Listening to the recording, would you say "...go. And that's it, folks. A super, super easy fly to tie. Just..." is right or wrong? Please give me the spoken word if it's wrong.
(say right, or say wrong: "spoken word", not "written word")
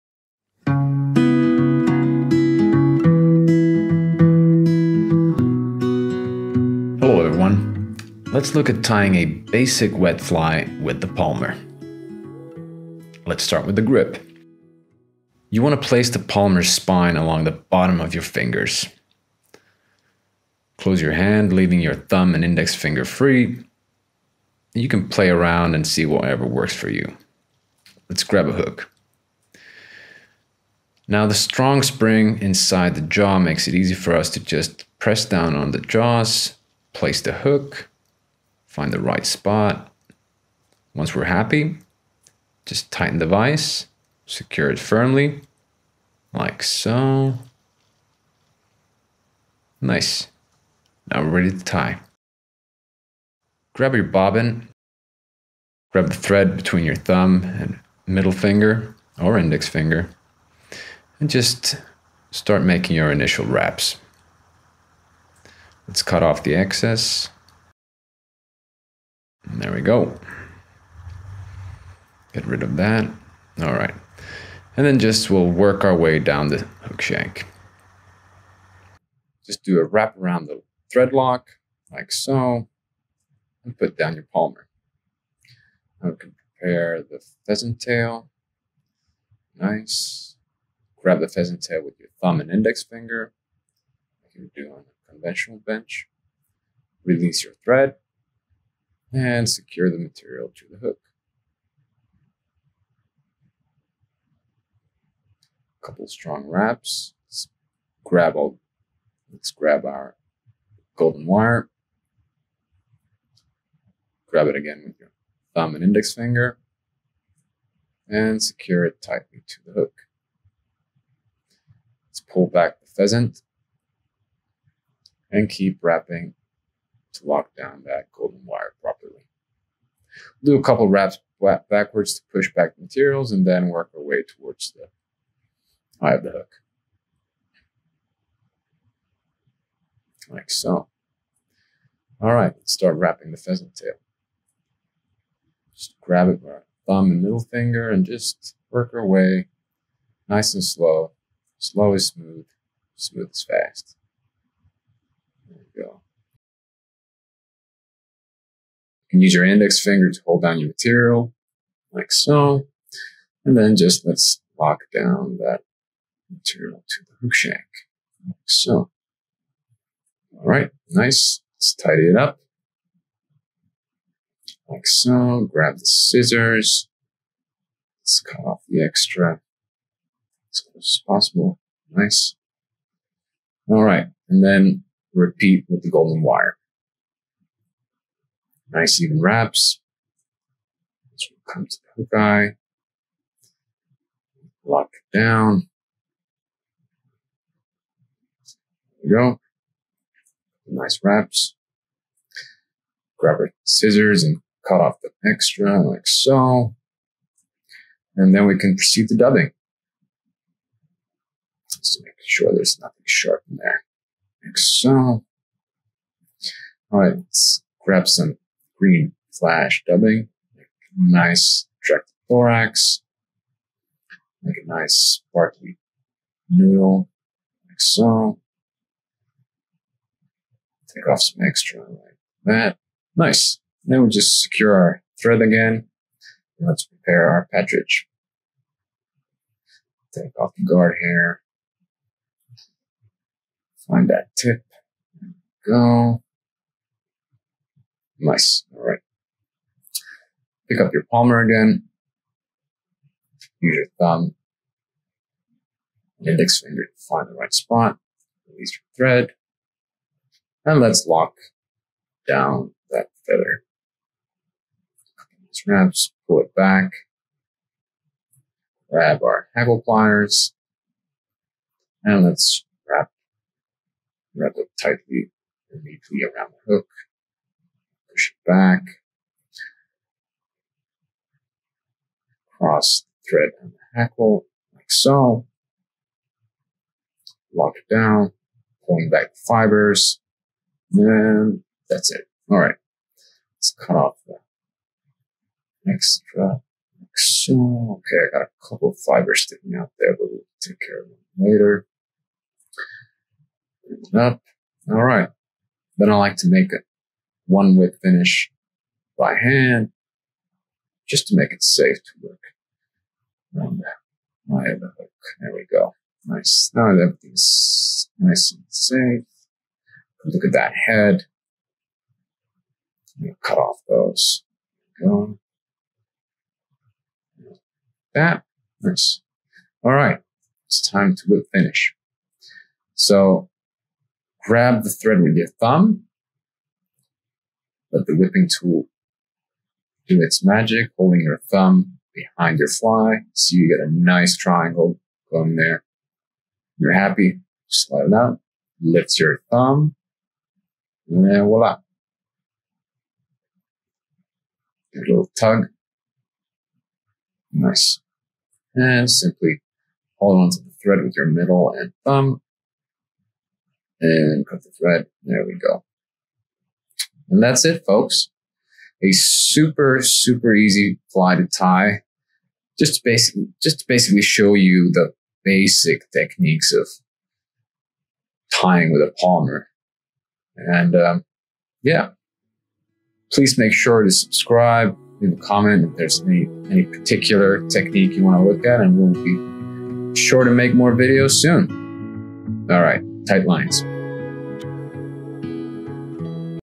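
right.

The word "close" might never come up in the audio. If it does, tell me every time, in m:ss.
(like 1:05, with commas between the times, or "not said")
0:20, 3:00.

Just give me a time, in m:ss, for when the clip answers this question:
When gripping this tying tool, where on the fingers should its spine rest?
0:17.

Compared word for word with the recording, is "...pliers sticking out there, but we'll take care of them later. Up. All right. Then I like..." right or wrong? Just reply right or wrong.
wrong.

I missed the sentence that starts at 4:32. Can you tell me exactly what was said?
And let's wrap, wrap it tightly and neatly around the hook back, cross thread and hackle, like so.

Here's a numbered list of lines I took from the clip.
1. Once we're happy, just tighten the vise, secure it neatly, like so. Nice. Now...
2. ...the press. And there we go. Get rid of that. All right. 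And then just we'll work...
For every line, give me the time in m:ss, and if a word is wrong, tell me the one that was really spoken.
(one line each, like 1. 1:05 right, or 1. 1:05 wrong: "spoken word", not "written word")
1. 0:40 wrong: "firmly", not "neatly"
2. 1:06 wrong: "excess", not "press".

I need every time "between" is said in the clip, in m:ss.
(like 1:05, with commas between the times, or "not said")
0:56.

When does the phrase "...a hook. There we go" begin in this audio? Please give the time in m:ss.
5:14.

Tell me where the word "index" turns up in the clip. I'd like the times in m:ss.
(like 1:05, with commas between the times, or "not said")
0:22, 0:59, 1:32, 1:55, 2:39, 4:16.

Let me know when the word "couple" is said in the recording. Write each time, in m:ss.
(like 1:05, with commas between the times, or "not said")
1:45, 2:10, 4:58.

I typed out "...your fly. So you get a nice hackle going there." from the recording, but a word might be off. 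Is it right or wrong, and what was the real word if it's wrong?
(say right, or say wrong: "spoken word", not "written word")
wrong: "triangle", not "hackle".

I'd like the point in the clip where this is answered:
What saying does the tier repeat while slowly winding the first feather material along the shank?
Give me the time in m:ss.
2:31.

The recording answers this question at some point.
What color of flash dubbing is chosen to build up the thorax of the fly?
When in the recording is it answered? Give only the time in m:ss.
3:38.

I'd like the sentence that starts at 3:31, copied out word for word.
Just make sure there's nothing sharp in there.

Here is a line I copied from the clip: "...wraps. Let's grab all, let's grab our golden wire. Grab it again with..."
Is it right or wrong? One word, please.
right.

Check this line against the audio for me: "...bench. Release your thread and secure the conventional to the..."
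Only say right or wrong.
wrong.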